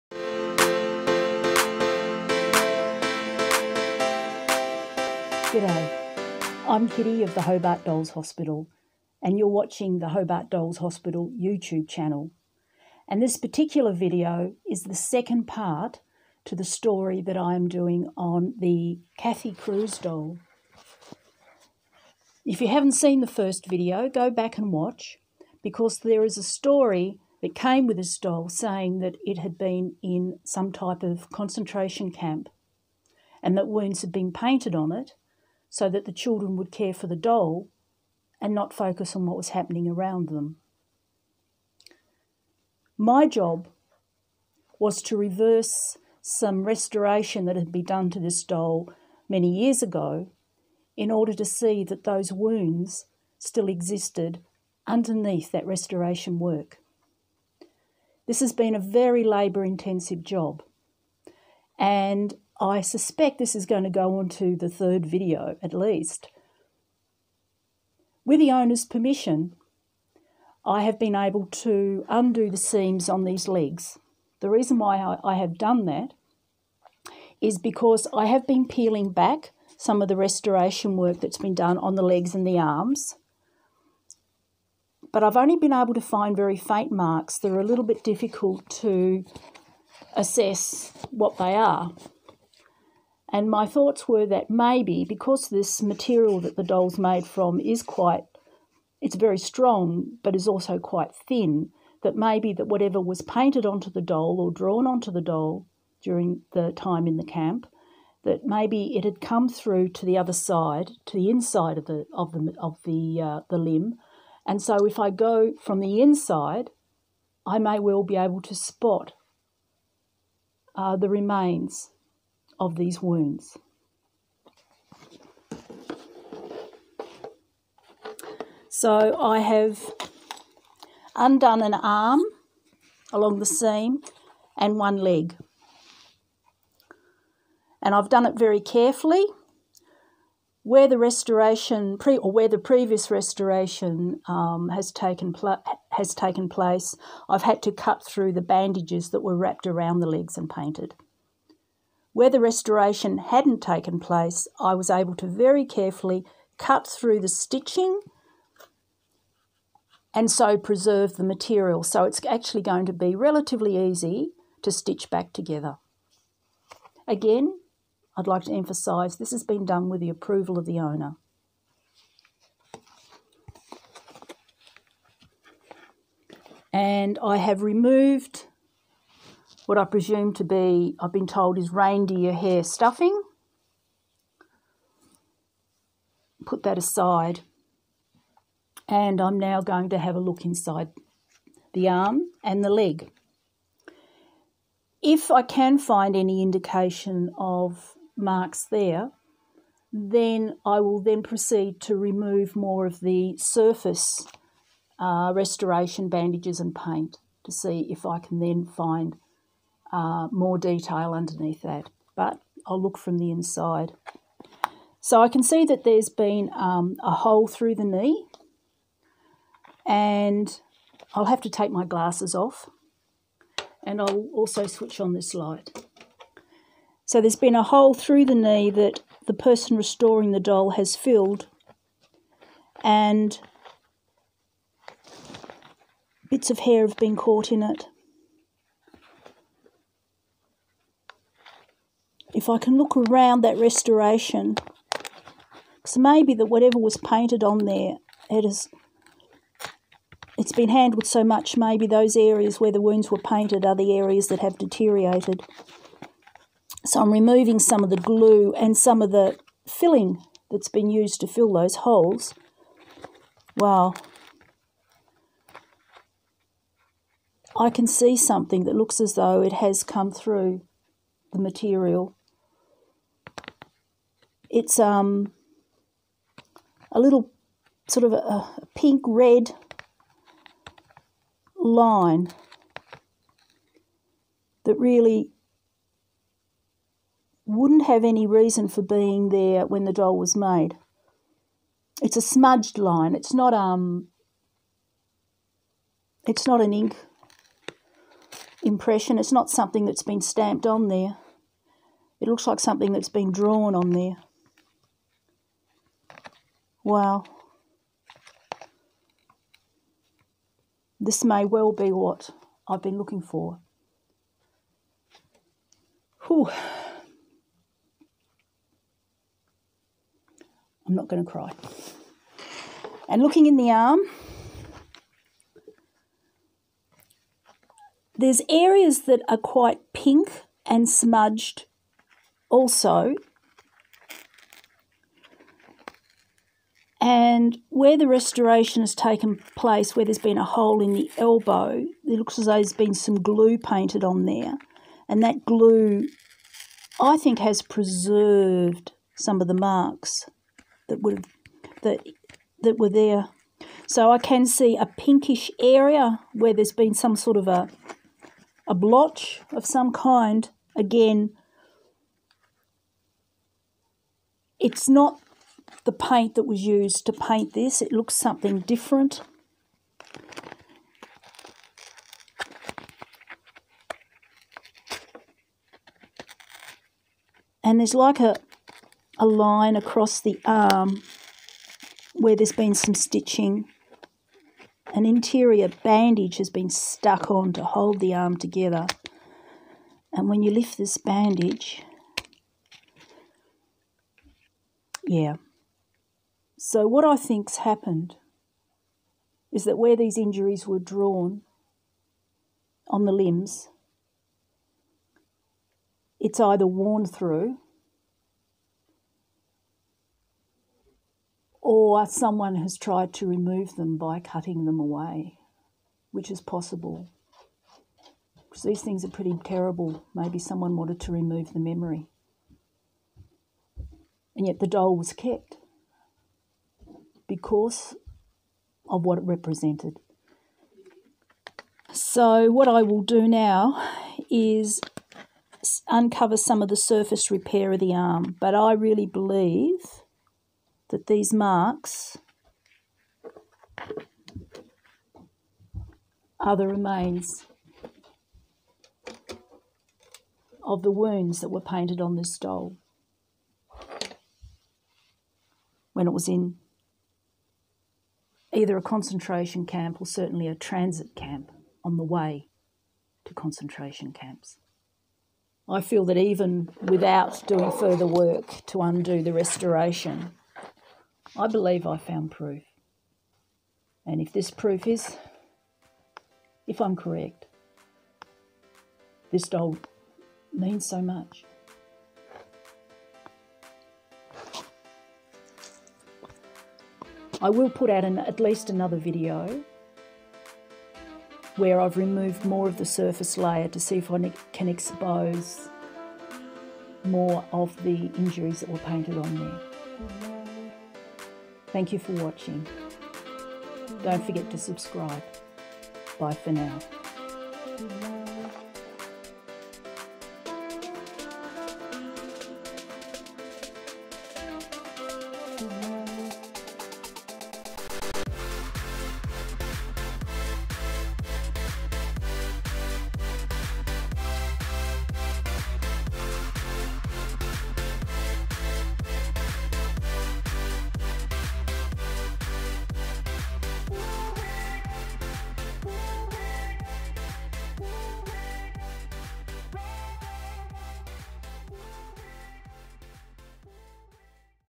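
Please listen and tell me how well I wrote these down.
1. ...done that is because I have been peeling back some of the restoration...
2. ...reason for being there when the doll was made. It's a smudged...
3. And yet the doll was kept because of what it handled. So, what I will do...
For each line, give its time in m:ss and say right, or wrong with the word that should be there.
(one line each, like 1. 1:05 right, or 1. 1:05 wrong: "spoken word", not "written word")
1. 1:15 right
2. 4:48 right
3. 7:04 wrong: "represented", not "handled".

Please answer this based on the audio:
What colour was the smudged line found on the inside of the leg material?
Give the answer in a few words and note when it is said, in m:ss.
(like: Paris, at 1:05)
Pink red, at 4:38.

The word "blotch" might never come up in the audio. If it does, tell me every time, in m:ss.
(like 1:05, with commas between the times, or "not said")
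5:58.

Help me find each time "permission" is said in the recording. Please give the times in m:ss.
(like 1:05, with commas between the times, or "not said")
1:08.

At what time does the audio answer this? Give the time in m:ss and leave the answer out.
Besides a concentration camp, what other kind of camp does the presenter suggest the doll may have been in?
7:40.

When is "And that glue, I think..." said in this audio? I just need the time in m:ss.
5:45.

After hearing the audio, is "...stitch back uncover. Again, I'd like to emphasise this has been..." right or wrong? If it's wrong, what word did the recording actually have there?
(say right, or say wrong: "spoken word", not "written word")
wrong: "together", not "uncover".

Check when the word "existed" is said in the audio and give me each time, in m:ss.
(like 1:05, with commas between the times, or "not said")
0:53.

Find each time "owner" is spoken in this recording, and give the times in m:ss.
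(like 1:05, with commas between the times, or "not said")
1:08, 2:50.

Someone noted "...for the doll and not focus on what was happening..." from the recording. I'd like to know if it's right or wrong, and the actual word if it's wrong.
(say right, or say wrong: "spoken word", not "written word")
right.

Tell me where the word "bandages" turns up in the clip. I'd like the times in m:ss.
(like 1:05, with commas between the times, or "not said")
2:28, 3:26, 6:25, 6:30.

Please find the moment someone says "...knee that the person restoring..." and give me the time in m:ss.
3:48.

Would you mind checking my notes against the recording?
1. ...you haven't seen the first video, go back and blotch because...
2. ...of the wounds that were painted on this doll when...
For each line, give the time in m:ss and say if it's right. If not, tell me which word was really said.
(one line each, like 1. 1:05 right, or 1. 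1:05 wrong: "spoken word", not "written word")
1. 0:22 wrong: "watch", not "blotch"
2. 7:30 right.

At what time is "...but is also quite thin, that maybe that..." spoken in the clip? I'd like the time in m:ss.
1:40.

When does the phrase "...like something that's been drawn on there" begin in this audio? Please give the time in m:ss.
5:02.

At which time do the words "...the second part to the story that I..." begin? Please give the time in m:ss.
0:14.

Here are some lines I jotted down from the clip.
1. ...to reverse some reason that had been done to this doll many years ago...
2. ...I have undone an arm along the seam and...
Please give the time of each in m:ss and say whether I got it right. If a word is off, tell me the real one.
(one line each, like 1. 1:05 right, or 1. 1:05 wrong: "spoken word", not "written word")
1. 0:45 wrong: "restoration", not "reason"
2. 2:09 right.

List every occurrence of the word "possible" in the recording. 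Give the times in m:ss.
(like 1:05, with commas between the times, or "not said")
6:56.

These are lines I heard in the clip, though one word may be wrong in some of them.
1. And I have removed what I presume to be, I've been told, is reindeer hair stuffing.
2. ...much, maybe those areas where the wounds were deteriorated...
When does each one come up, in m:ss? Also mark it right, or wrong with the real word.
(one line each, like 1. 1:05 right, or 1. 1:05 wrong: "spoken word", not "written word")
1. 2:56 right
2. 4:11 wrong: "painted", not "deteriorated".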